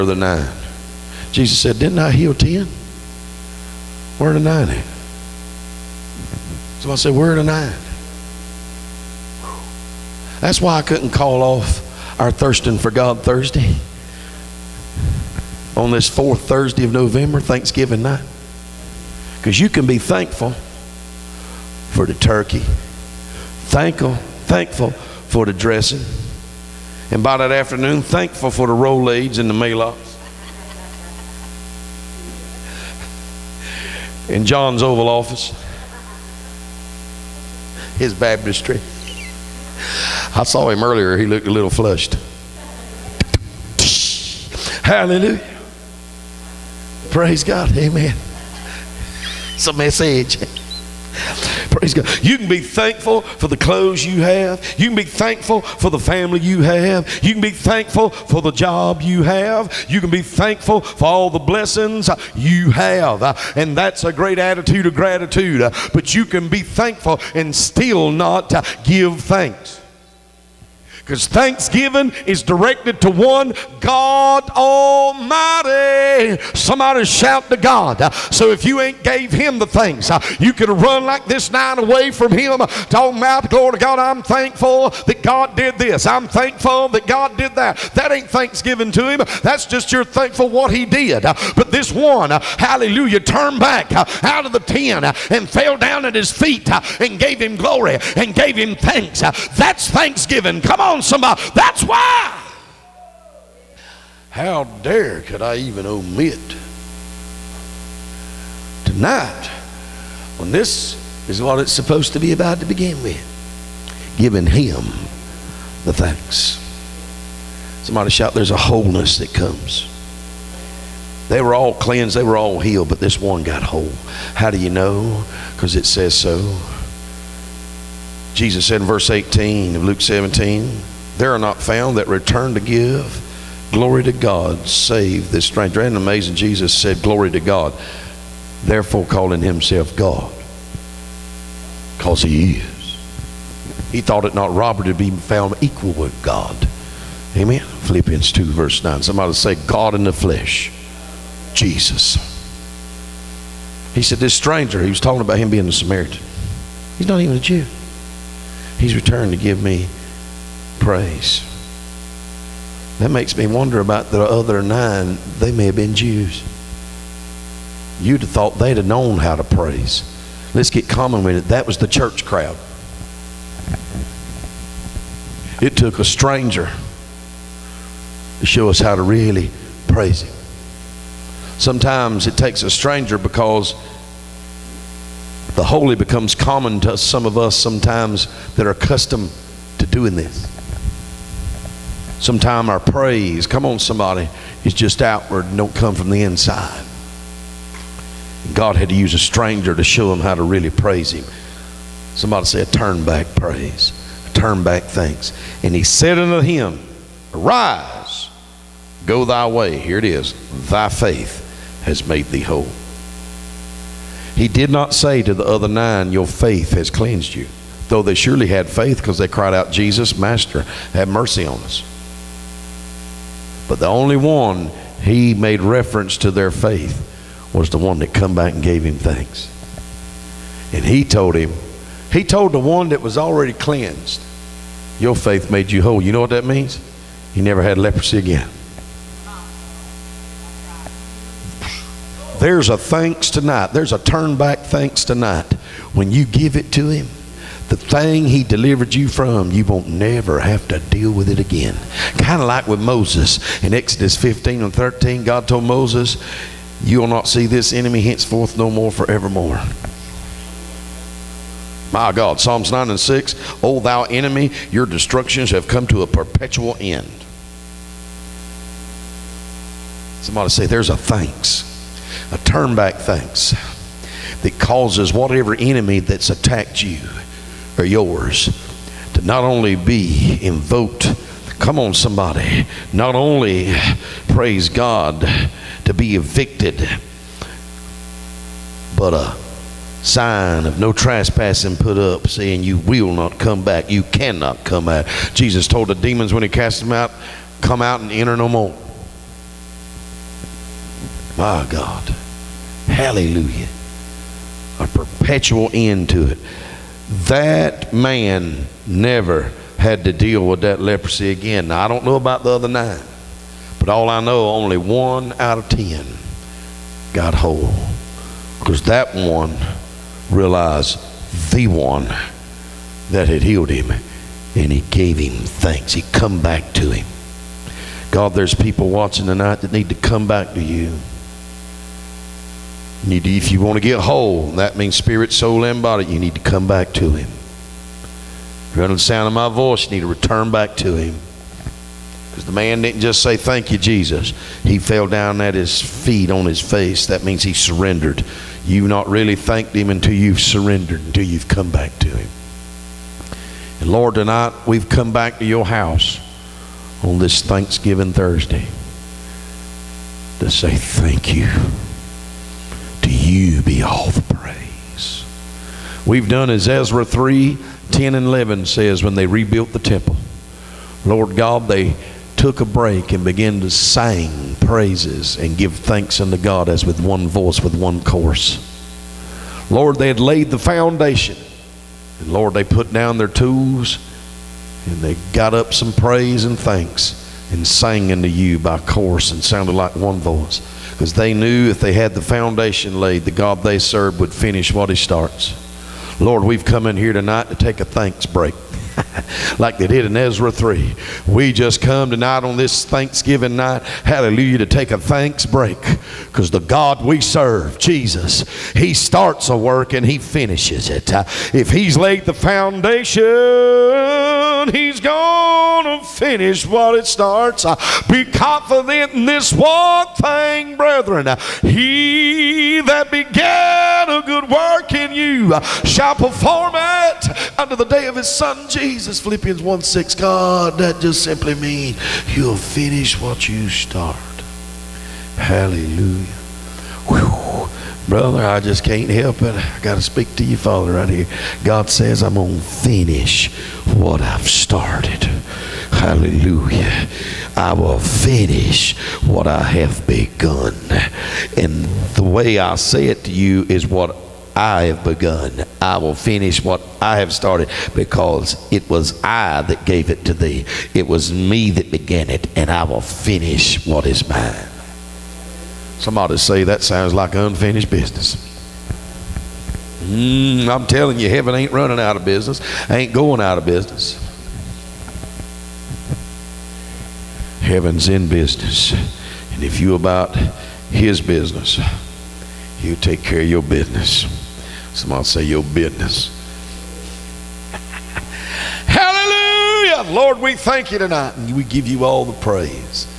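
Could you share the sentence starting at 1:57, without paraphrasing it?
Somebody shout, There's a wholeness that comes.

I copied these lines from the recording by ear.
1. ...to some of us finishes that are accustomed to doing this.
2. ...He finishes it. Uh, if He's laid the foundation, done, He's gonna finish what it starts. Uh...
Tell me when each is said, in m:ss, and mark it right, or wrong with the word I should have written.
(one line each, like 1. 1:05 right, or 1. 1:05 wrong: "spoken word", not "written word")
1. 3:06 wrong: "sometimes", not "finishes"
2. 6:50 right.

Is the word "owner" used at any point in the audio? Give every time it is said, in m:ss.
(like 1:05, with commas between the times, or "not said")
not said.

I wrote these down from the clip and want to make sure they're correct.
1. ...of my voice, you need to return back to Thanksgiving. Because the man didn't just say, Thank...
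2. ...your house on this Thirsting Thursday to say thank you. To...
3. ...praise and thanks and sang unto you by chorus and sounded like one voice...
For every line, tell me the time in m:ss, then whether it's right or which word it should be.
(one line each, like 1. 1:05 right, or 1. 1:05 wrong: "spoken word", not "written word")
1. 5:39 wrong: "Him", not "Thanksgiving"
2. 5:55 wrong: "Thanksgiving", not "Thirsting"
3. 6:25 right.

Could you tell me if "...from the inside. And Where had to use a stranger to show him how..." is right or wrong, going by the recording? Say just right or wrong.
wrong.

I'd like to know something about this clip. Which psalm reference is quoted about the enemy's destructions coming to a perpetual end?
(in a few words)
Psalms 9:6.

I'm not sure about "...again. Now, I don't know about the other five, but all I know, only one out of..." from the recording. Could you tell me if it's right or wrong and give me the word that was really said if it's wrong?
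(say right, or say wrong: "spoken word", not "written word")
wrong: "nine", not "five".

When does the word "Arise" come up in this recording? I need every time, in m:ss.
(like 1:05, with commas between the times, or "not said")
3:27.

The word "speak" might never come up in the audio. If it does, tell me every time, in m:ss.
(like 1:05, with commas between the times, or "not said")
7:20.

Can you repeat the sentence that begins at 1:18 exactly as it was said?
So if you ain't gave him the things, you can run like this nine away from him.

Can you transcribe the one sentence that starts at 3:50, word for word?
And he told him, he told the one that was already cleansed, Your faith made you whole.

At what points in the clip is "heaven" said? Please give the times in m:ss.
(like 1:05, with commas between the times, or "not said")
7:51, 7:57.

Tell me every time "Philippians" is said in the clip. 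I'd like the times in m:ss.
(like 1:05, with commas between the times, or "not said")
2:27, 7:09.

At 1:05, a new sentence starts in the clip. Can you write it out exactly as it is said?
But you can be thankful and still not give thanks because thanksgiving is directed to one God Almighty.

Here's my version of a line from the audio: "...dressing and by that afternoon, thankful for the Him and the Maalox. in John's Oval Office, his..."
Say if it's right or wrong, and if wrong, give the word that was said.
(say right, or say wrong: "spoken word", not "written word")
wrong: "Rolaids", not "Him".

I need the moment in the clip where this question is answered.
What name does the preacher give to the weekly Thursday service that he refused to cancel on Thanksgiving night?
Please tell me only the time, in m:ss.
0:12.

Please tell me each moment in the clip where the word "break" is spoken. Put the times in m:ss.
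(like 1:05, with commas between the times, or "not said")
6:12, 6:38, 6:45.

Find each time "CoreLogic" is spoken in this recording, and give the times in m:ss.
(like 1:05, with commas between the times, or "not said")
not said.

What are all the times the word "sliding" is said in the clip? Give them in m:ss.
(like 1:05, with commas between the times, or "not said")
not said.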